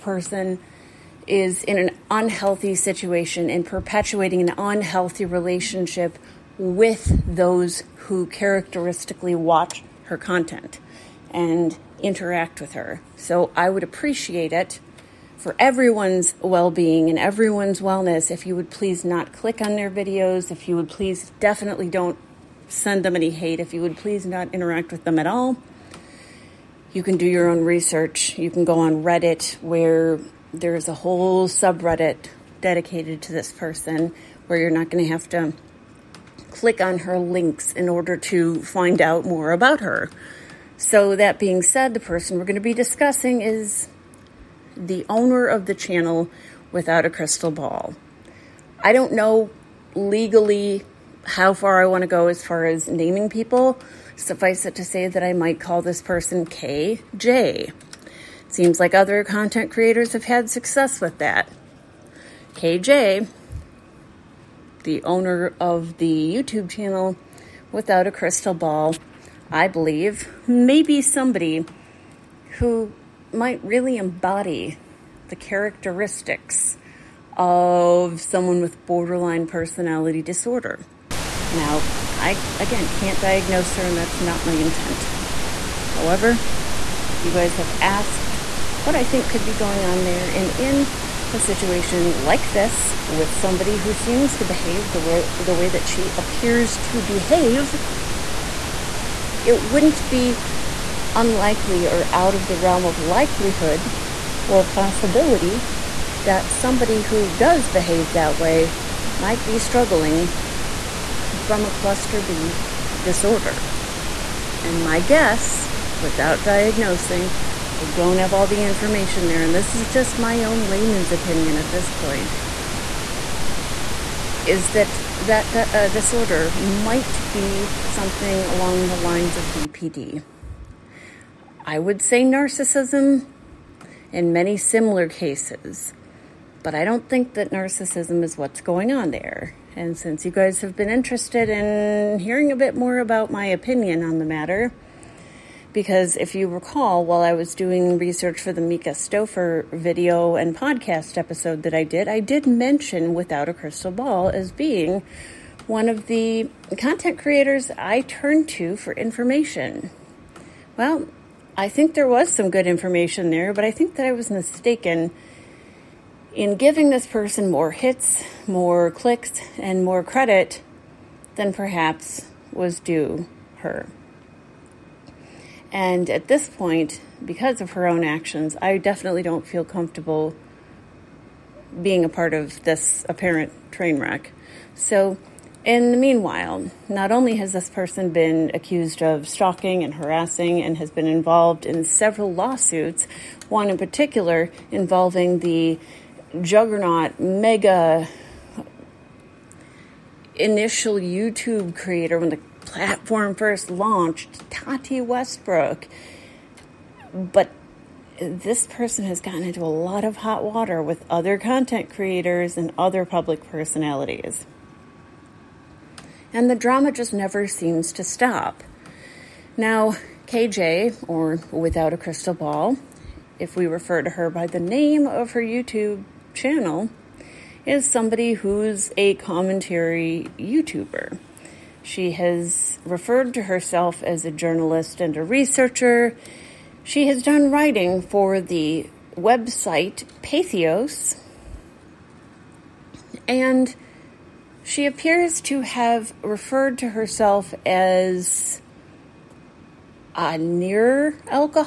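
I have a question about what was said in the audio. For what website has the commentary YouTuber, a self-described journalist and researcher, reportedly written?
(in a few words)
Pathos.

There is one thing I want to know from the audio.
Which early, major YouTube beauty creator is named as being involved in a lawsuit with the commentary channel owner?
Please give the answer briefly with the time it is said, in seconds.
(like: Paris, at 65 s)
Tati Westbrook, at 204 s.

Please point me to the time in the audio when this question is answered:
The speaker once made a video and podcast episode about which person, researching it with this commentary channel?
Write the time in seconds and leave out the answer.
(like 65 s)
148 s.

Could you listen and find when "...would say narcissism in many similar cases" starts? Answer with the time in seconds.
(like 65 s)
131 s.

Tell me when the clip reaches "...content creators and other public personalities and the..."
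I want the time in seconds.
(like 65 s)
211 s.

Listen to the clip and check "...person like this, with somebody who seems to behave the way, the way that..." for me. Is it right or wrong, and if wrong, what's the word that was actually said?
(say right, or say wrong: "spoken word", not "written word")
wrong: "situation", not "person".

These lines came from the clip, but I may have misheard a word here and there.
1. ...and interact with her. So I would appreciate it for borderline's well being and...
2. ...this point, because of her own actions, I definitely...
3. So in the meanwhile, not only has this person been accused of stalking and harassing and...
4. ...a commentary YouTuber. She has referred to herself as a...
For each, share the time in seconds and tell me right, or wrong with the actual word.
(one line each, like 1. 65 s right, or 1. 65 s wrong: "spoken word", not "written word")
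1. 11 s wrong: "everyone", not "borderline"
2. 176 s right
3. 184 s right
4. 228 s right.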